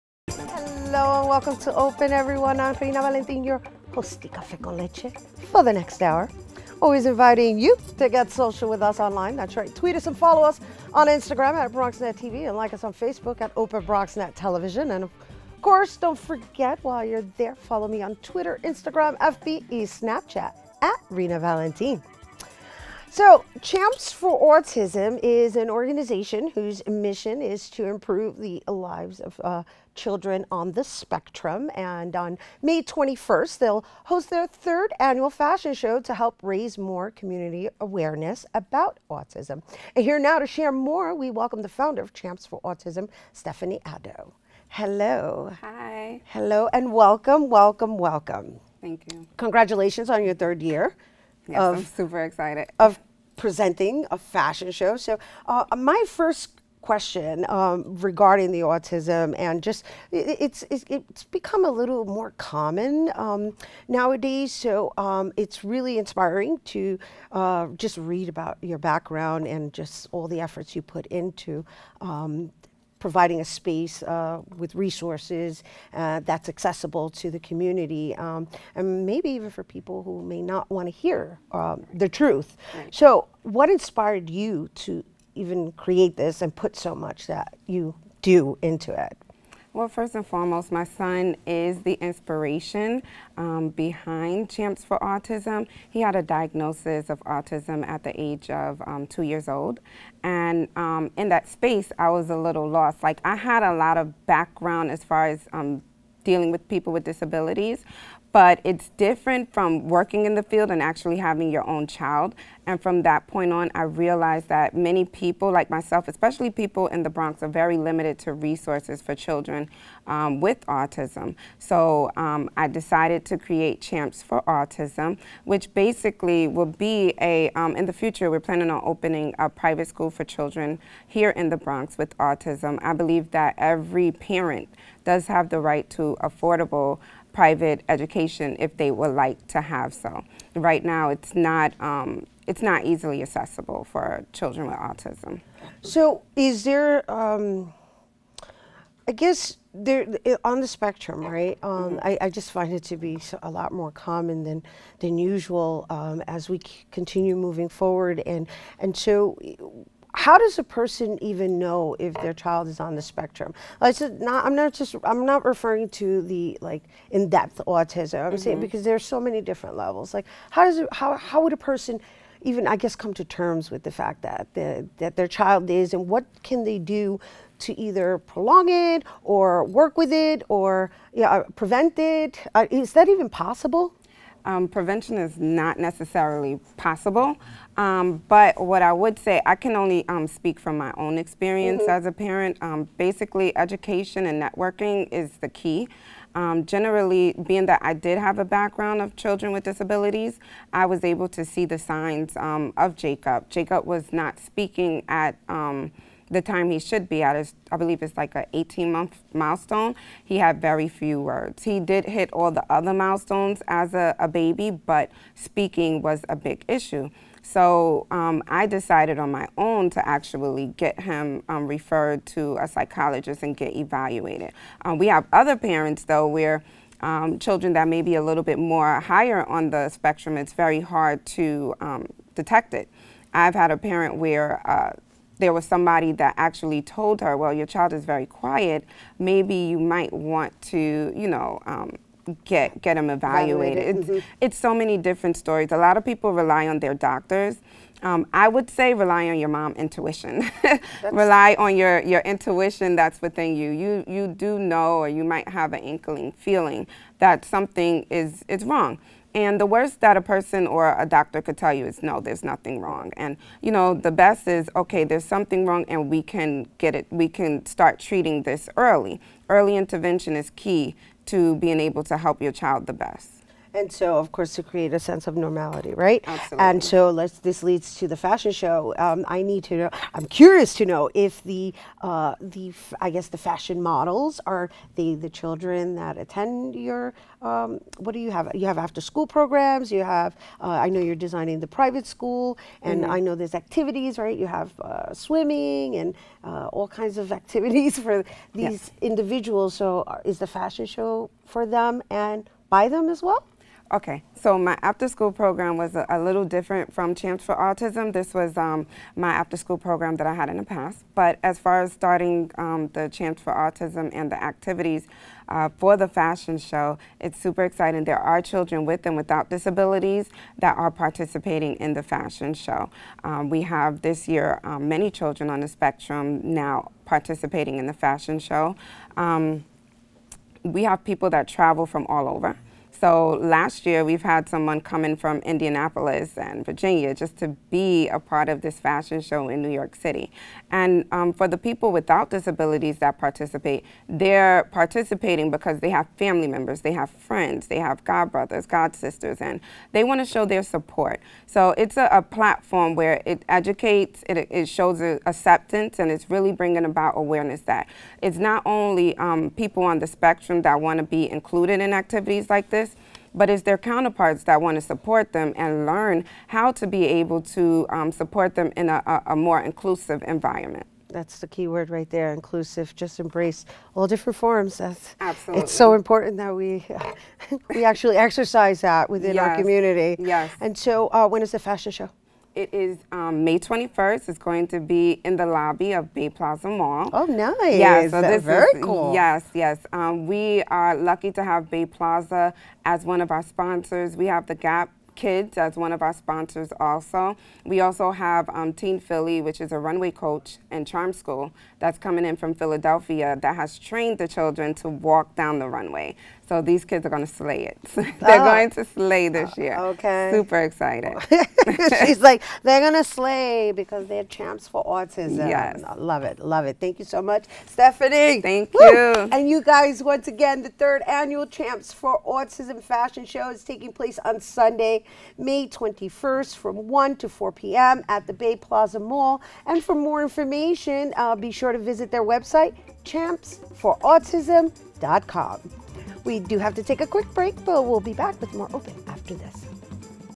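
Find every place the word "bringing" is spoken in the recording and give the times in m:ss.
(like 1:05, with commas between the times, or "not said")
5:56.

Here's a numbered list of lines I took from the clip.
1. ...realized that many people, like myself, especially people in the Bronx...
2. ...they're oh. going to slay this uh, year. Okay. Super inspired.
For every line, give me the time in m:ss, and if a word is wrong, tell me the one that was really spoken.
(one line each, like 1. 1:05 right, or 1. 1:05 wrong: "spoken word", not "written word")
1. 1:53 right
2. 6:47 wrong: "excited", not "inspired".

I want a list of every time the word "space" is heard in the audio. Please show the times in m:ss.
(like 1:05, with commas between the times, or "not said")
1:13, 1:41.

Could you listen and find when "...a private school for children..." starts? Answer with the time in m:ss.
2:09.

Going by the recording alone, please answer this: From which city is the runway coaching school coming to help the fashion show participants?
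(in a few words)
Philadelphia.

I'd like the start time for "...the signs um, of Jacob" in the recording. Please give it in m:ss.
3:21.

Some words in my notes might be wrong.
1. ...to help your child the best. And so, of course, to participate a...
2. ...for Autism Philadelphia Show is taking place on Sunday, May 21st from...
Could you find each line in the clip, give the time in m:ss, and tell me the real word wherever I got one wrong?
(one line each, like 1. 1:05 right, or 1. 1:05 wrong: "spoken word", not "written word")
1. 4:32 wrong: "create", not "participate"
2. 7:01 wrong: "Fashion", not "Philadelphia".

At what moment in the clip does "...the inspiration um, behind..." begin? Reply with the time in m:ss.
1:31.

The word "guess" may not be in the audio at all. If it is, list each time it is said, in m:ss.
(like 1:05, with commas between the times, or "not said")
2:29, 2:52, 4:43.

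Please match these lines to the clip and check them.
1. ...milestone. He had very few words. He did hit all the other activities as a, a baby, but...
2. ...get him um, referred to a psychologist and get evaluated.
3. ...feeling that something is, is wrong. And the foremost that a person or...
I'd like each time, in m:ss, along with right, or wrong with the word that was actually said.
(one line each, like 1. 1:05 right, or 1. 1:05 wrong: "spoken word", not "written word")
1. 3:29 wrong: "milestones", not "activities"
2. 3:40 right
3. 4:16 wrong: "worst", not "foremost".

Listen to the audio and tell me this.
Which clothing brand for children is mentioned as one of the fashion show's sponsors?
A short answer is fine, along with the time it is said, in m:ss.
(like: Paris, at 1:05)
Gap Kids, at 6:34.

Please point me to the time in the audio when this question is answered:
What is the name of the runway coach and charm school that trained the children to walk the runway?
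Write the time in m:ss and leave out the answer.
6:38.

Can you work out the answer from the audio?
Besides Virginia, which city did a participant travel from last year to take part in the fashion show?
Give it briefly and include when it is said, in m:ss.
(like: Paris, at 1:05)
Indianapolis, at 5:35.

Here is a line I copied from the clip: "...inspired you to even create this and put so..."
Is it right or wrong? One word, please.
right.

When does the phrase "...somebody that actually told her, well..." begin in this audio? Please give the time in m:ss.
3:55.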